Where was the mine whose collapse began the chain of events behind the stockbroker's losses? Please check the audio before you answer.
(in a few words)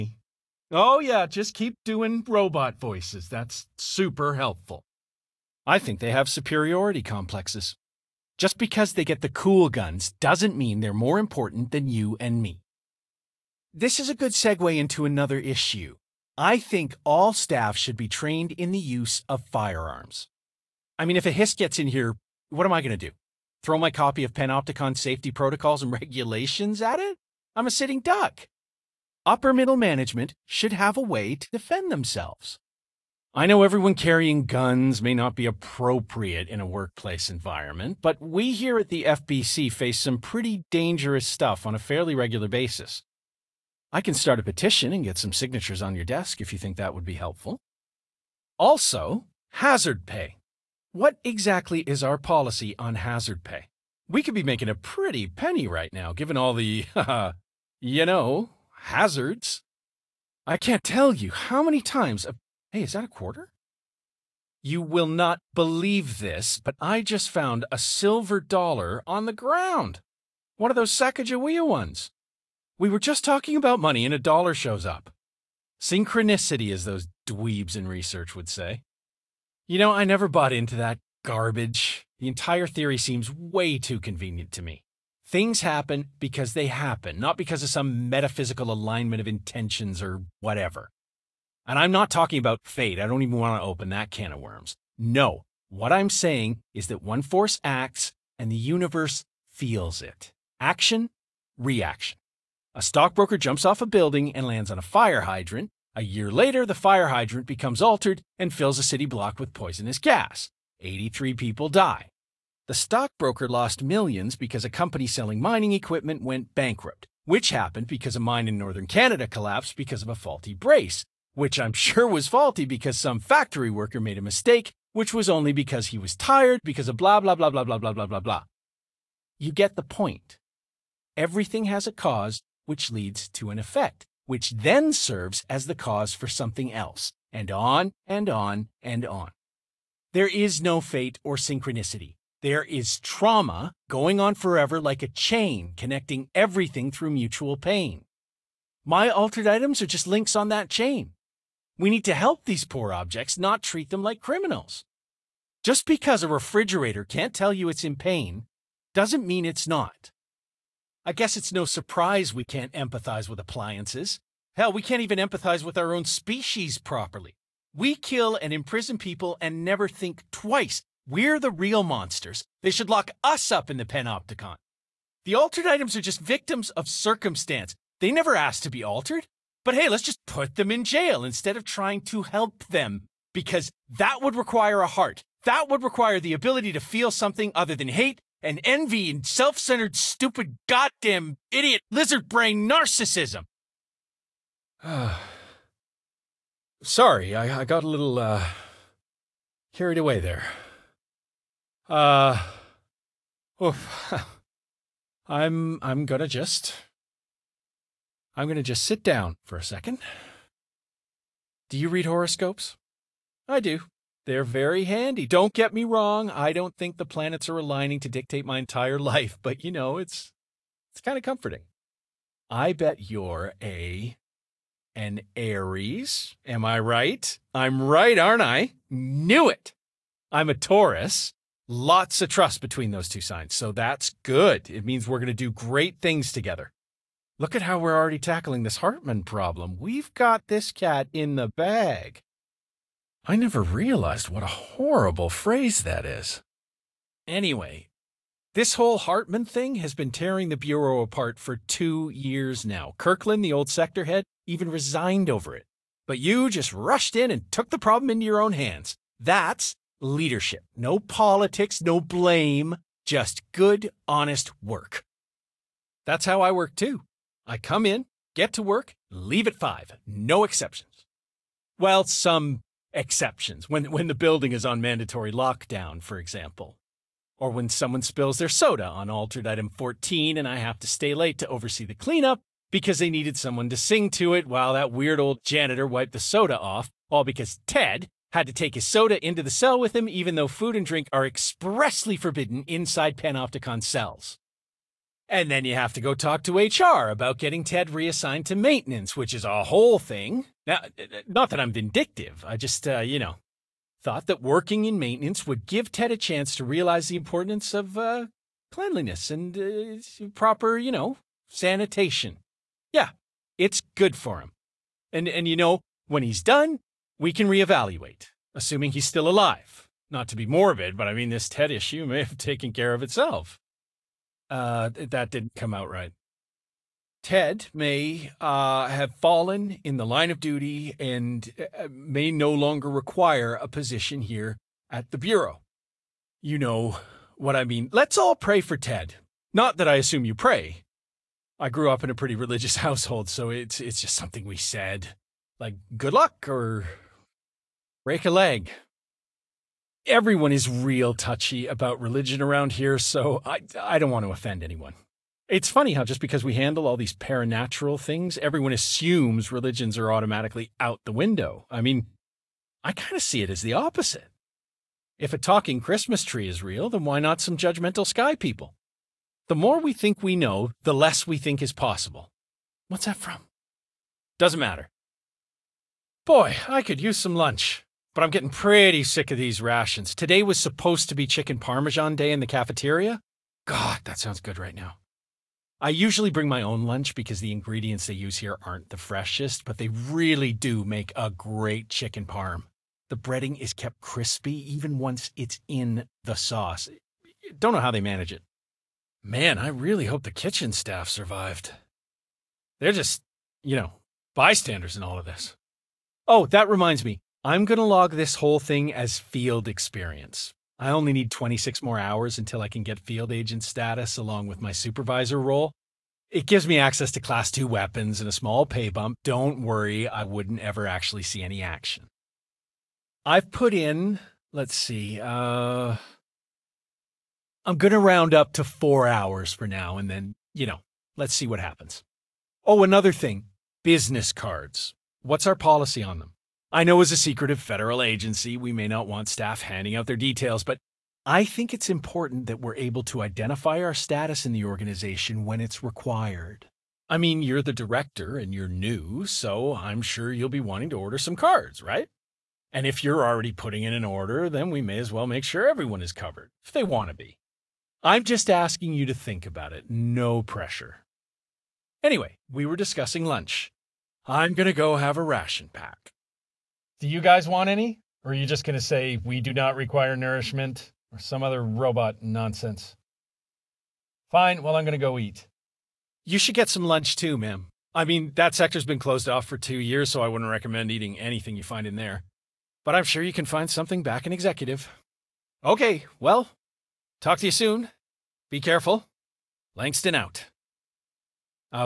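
northern Canada.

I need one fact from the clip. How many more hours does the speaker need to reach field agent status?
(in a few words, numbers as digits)
26.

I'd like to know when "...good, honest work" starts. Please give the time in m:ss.
4:23.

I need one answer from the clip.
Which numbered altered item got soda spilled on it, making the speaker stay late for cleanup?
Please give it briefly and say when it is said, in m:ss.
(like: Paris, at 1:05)
altered item 14, at 4:39.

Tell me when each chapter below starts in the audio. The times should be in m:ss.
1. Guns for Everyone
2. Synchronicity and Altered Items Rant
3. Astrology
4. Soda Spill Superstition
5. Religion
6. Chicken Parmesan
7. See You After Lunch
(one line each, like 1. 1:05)
1. 0:12
2. 1:03
3. 3:30
4. 4:25
5. 5:48
6. 6:15
7. 7:40.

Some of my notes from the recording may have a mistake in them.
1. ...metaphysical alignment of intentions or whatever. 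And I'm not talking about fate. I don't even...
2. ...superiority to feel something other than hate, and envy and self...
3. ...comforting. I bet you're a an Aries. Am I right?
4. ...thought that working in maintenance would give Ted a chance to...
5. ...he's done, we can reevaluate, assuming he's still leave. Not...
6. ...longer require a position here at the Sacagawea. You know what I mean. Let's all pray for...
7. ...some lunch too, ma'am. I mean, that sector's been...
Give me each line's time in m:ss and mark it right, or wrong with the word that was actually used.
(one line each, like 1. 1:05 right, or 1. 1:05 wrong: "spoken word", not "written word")
1. 1:28 right
2. 3:06 wrong: "ability", not "superiority"
3. 3:41 right
4. 5:04 right
5. 5:16 wrong: "alive", not "leave"
6. 5:32 wrong: "Bureau", not "Sacagawea"
7. 7:56 right.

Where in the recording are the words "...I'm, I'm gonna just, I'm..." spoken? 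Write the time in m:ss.
3:25.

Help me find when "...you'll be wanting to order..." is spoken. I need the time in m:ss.
7:30.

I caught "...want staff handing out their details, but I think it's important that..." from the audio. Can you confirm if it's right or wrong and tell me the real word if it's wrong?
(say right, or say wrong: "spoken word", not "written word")
right.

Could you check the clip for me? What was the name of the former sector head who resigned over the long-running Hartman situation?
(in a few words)
Kirkland.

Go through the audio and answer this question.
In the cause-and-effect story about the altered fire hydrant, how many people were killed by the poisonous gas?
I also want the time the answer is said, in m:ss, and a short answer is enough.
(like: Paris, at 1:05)
83, at 1:50.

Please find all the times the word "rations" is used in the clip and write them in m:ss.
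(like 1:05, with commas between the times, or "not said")
6:19, 7:45.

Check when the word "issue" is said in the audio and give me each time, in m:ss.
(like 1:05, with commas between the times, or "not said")
0:15, 5:21.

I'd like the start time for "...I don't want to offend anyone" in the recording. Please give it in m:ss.
5:53.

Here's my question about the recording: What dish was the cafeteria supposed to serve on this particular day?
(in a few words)
chicken parmesan.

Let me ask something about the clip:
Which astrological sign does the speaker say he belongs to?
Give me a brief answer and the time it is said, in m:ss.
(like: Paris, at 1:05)
Taurus, at 3:50.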